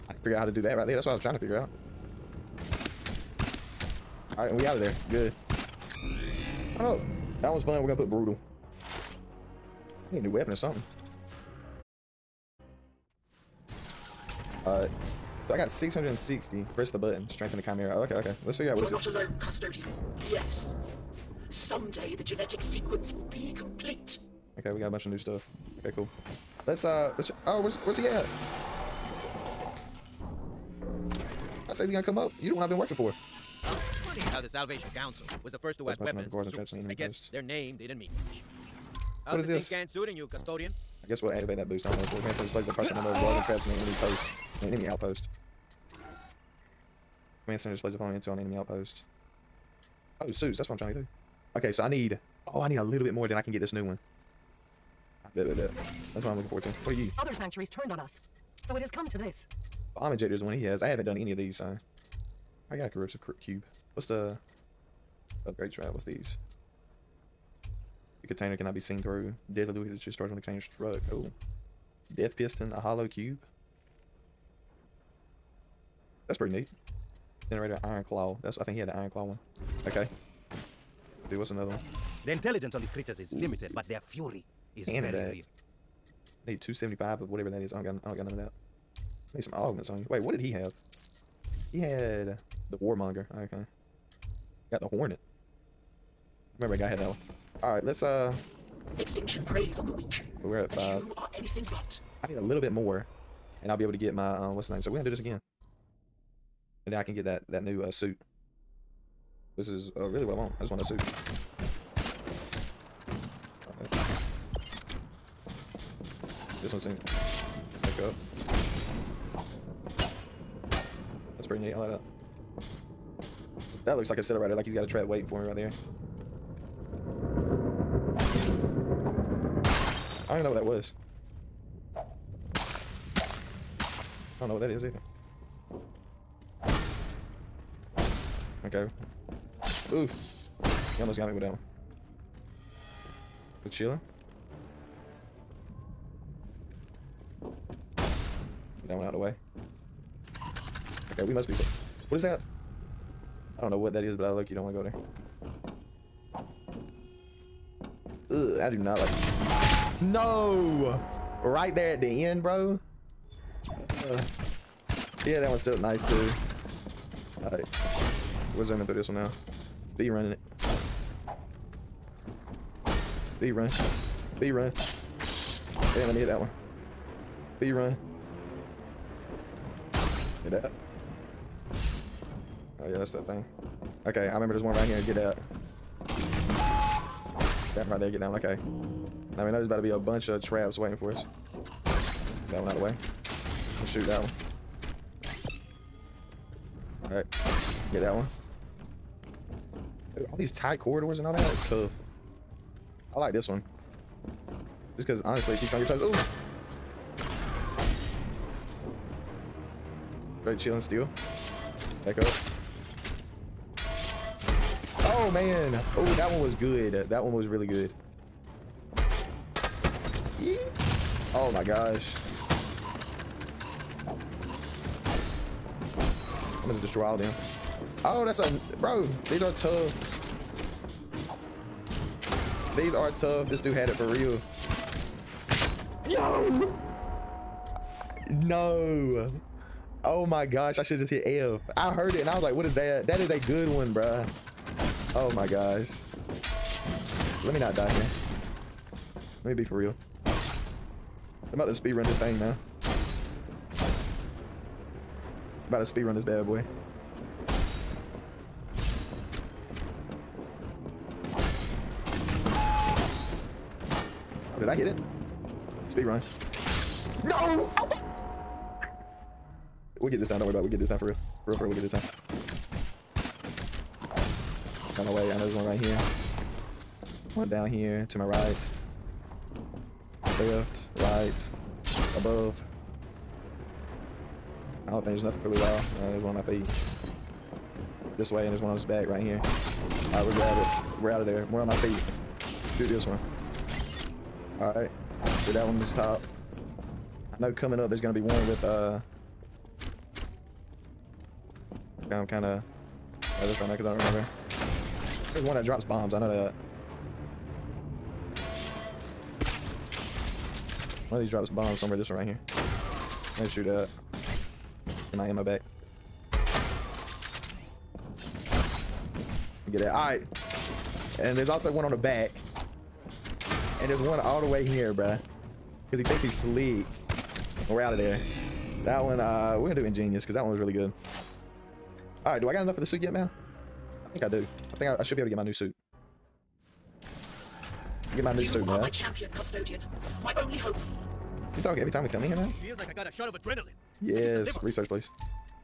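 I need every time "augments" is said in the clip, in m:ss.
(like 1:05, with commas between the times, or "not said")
1:29.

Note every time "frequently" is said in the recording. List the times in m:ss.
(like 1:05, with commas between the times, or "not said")
not said.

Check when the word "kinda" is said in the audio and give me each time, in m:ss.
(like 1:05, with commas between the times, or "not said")
5:02.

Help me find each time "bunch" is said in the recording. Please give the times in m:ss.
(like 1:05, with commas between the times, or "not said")
0:24, 3:09.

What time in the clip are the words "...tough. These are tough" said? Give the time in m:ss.
3:49.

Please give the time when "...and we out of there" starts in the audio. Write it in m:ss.
0:04.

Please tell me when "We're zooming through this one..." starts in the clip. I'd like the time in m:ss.
2:48.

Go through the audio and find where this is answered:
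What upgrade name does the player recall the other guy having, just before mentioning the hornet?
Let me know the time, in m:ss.
1:32.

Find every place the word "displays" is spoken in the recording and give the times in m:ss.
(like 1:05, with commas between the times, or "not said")
0:42, 0:47.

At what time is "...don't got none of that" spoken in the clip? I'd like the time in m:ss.
1:28.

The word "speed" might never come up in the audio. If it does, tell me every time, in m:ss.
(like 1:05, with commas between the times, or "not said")
4:11, 4:15.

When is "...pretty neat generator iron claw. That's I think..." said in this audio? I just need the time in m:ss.
1:16.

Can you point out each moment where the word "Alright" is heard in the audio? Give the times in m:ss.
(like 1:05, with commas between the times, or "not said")
1:37, 2:47, 3:17, 4:50, 4:54.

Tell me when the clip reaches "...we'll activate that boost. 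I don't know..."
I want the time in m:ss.
0:41.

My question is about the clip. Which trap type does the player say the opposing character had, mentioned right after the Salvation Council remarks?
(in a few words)
Bomb ejector.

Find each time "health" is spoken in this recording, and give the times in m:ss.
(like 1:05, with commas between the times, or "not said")
not said.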